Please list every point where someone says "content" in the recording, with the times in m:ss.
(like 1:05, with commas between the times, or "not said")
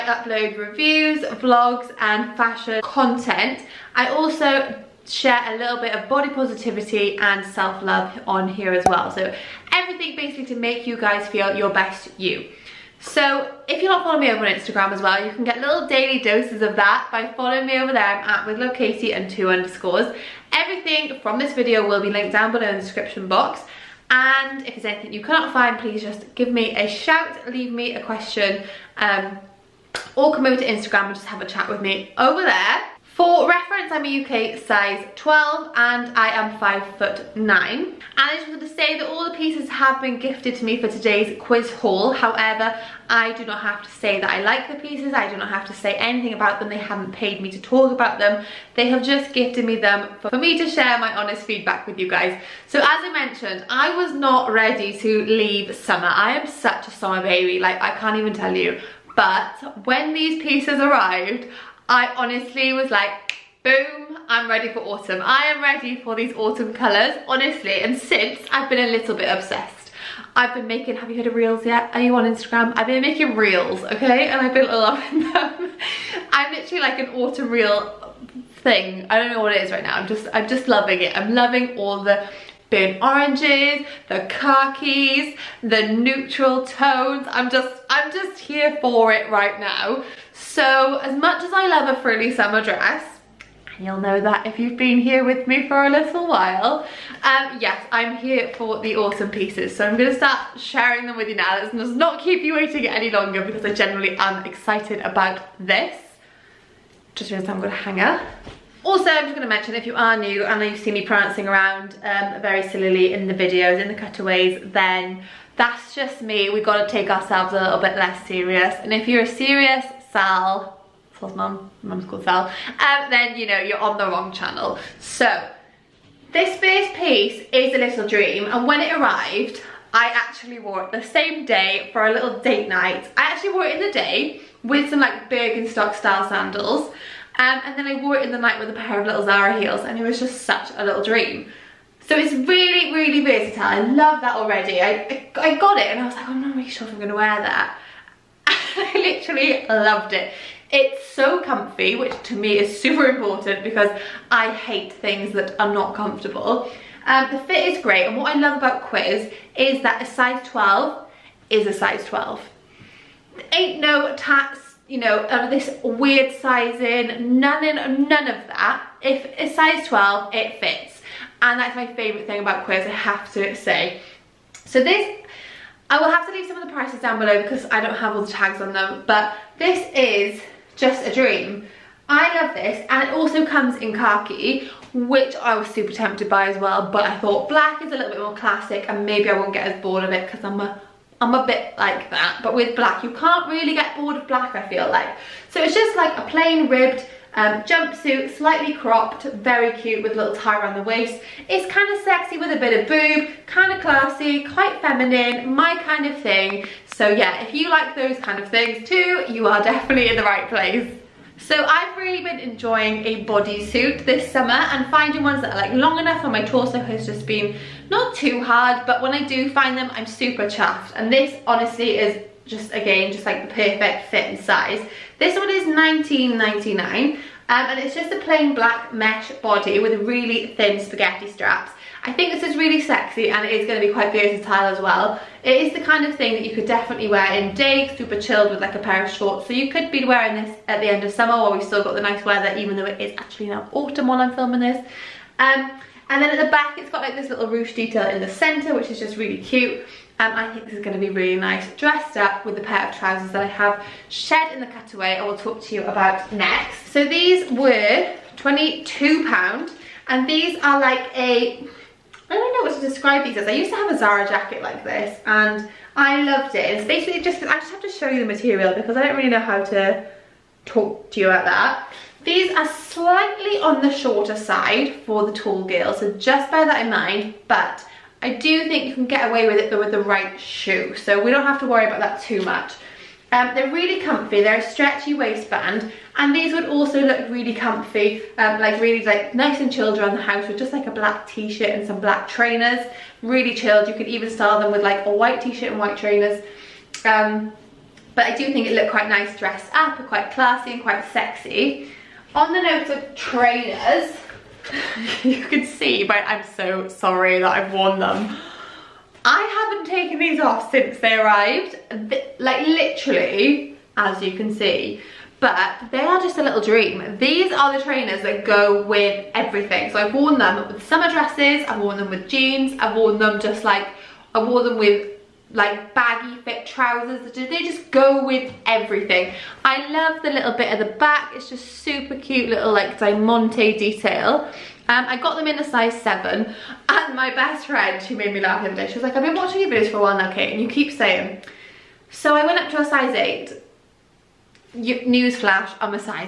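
0:02.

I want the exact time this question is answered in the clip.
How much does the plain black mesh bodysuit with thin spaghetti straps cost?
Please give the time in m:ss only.
3:45.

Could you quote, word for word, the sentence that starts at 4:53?
Really chilled, you could even style them with like a white t-shirt and white trainers.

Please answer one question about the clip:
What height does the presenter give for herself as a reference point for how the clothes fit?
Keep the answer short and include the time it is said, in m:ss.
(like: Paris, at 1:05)
5 foot 9, at 0:36.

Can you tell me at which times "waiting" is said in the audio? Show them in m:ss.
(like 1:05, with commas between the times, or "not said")
1:42.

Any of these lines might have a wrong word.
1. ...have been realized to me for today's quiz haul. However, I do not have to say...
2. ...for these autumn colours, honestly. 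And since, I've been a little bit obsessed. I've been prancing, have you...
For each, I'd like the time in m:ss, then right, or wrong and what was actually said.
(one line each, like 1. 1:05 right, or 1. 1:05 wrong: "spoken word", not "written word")
1. 0:39 wrong: "gifted", not "realized"
2. 1:06 wrong: "making", not "prancing".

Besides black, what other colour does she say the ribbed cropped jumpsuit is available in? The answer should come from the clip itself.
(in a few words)
khaki.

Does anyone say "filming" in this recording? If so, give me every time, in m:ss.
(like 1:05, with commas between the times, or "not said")
4:04.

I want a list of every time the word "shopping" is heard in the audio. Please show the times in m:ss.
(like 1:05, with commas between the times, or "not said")
not said.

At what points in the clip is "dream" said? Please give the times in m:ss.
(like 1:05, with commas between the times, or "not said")
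2:08, 2:21, 3:01, 5:16.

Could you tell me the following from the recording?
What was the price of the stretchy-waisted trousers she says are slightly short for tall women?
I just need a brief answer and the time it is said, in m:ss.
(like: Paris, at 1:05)
£22, at 4:18.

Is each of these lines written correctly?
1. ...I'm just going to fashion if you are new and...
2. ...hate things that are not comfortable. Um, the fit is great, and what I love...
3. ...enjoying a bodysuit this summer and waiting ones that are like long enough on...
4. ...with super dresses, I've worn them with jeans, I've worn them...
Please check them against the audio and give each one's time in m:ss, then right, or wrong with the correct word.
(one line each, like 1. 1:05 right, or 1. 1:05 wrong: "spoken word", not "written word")
1. 1:49 wrong: "mention", not "fashion"
2. 2:34 right
3. 3:32 wrong: "finding", not "waiting"
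4. 5:20 wrong: "summer", not "super".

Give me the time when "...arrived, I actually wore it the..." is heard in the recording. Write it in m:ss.
2:08.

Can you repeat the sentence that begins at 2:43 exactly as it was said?
Ain't no tats, you know, of this weird sizing, none, in, none of that.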